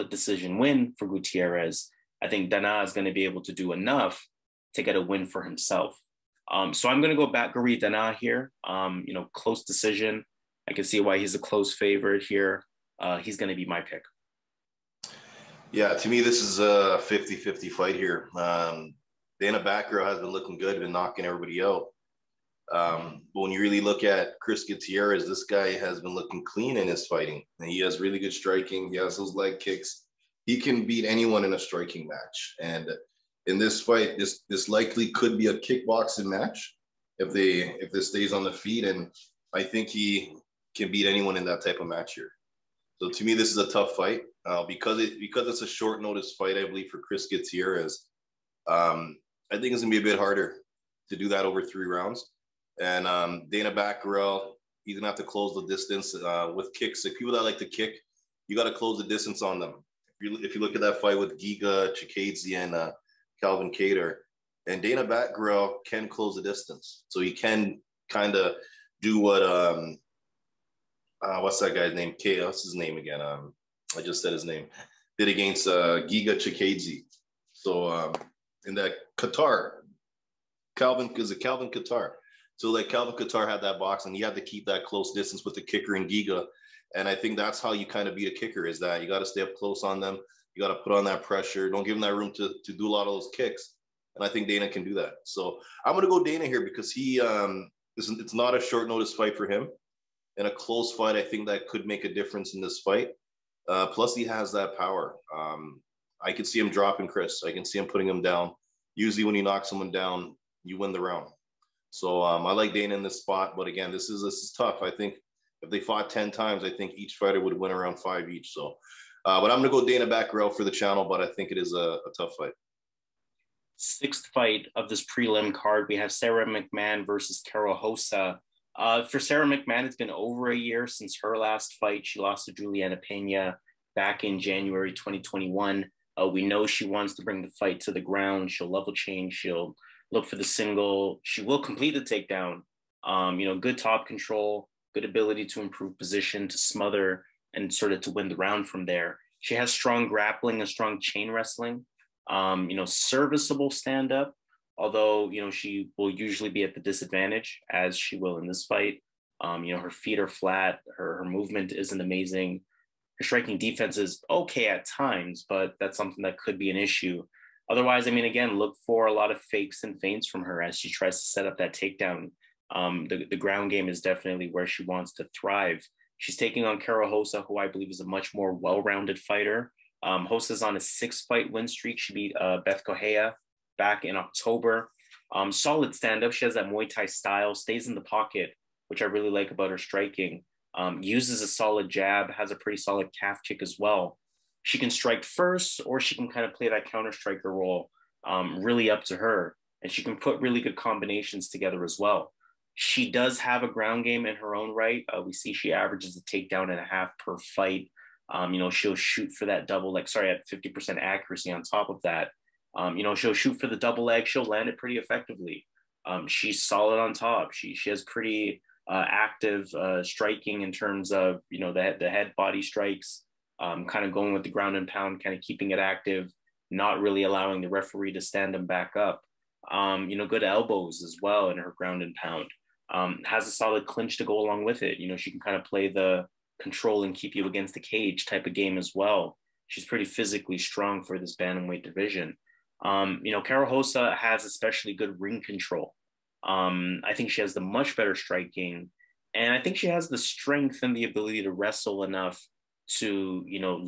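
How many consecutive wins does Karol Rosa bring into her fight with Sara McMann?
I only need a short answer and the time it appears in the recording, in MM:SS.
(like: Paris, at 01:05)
6, at 03:00.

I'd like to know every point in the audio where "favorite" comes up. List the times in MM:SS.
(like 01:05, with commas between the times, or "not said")
00:11.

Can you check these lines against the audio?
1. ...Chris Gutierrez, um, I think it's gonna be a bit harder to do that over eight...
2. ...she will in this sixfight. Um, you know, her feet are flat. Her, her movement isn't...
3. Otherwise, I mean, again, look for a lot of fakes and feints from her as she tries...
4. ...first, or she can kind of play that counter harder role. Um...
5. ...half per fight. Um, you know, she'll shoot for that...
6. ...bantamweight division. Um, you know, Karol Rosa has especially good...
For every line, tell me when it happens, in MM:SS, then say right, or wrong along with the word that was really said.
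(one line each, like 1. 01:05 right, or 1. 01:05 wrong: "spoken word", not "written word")
1. 00:46 wrong: "three", not "eight"
2. 02:37 wrong: "fight", not "sixfight"
3. 02:47 right
4. 03:15 wrong: "striker", not "harder"
5. 03:26 right
6. 04:01 right.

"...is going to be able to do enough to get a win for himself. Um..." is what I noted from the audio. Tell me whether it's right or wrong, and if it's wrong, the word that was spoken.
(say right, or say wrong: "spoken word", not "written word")
right.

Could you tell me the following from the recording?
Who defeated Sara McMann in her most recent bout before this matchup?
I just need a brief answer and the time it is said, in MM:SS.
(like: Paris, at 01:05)
Juliana Pena, at 02:12.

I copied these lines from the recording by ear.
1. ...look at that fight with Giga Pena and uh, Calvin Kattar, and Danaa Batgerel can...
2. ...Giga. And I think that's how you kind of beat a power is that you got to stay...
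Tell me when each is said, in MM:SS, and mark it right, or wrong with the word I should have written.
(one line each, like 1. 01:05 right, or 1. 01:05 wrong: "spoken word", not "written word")
1. 01:00 wrong: "Chikadze", not "Pena"
2. 01:26 wrong: "kicker", not "power".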